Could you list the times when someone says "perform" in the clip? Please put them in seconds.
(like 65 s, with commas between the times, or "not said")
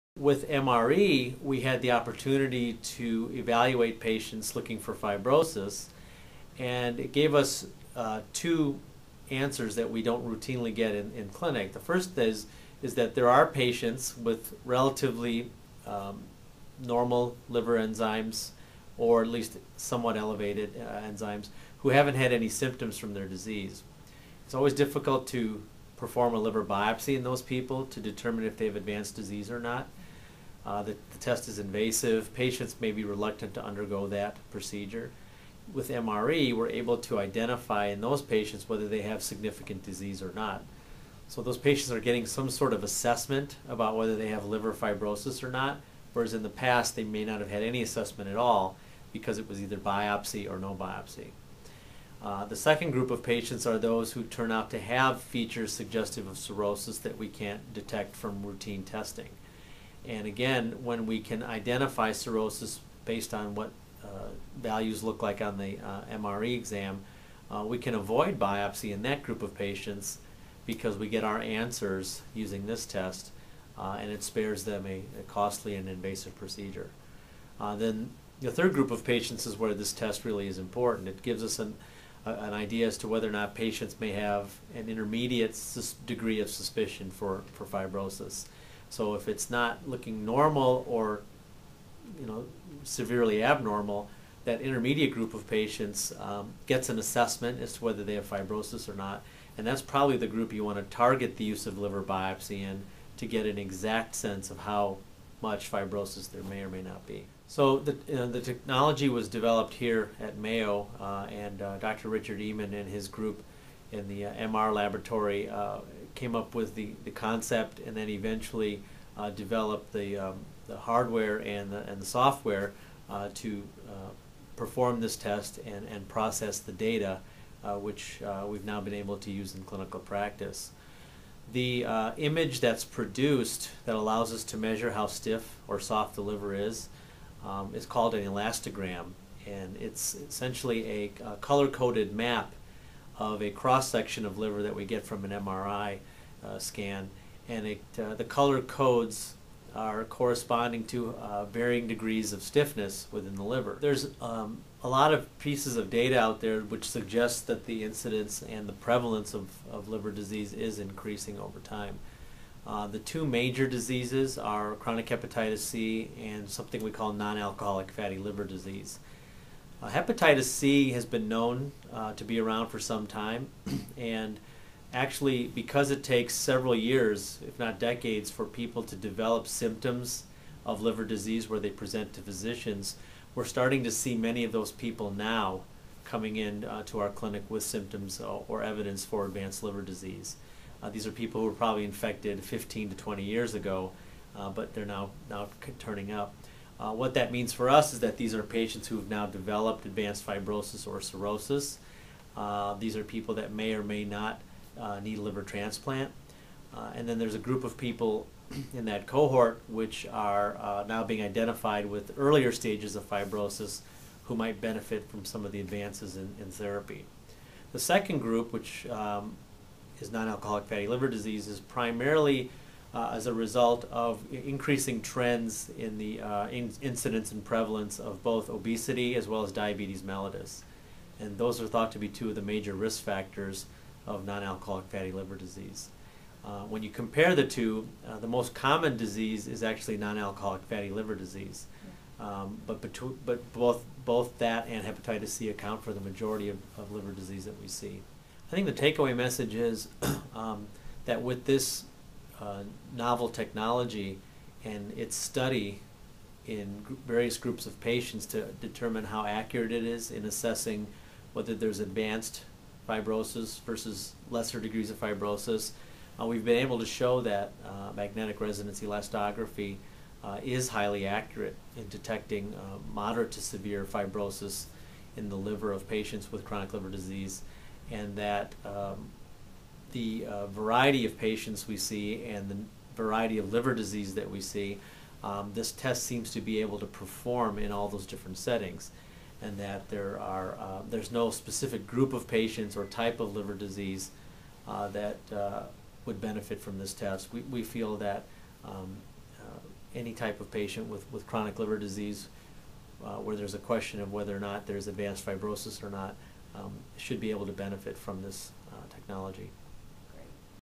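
26 s, 124 s, 286 s.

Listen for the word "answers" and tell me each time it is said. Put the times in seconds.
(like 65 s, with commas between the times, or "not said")
9 s, 71 s.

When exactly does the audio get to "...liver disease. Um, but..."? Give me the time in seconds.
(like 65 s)
240 s.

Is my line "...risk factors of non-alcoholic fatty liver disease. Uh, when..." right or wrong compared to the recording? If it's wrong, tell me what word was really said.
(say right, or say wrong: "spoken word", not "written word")
right.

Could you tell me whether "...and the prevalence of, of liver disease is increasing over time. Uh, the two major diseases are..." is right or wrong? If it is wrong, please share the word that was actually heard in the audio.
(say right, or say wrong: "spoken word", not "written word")
right.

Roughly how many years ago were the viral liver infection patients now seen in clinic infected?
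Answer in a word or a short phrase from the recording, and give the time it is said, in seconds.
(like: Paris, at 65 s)
15 to 20 years, at 192 s.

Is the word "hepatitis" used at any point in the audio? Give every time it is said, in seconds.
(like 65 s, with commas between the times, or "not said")
165 s, 169 s, 244 s.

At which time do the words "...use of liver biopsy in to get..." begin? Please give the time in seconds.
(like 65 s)
101 s.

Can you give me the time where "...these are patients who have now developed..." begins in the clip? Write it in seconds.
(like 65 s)
198 s.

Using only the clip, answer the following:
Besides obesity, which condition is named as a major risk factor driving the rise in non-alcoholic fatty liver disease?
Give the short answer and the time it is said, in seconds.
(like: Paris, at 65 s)
diabetes mellitus, at 229 s.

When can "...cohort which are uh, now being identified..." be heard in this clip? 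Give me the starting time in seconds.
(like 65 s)
209 s.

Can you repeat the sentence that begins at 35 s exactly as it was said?
With MRE, we're able to identify in those patients whether they have significant disease or not.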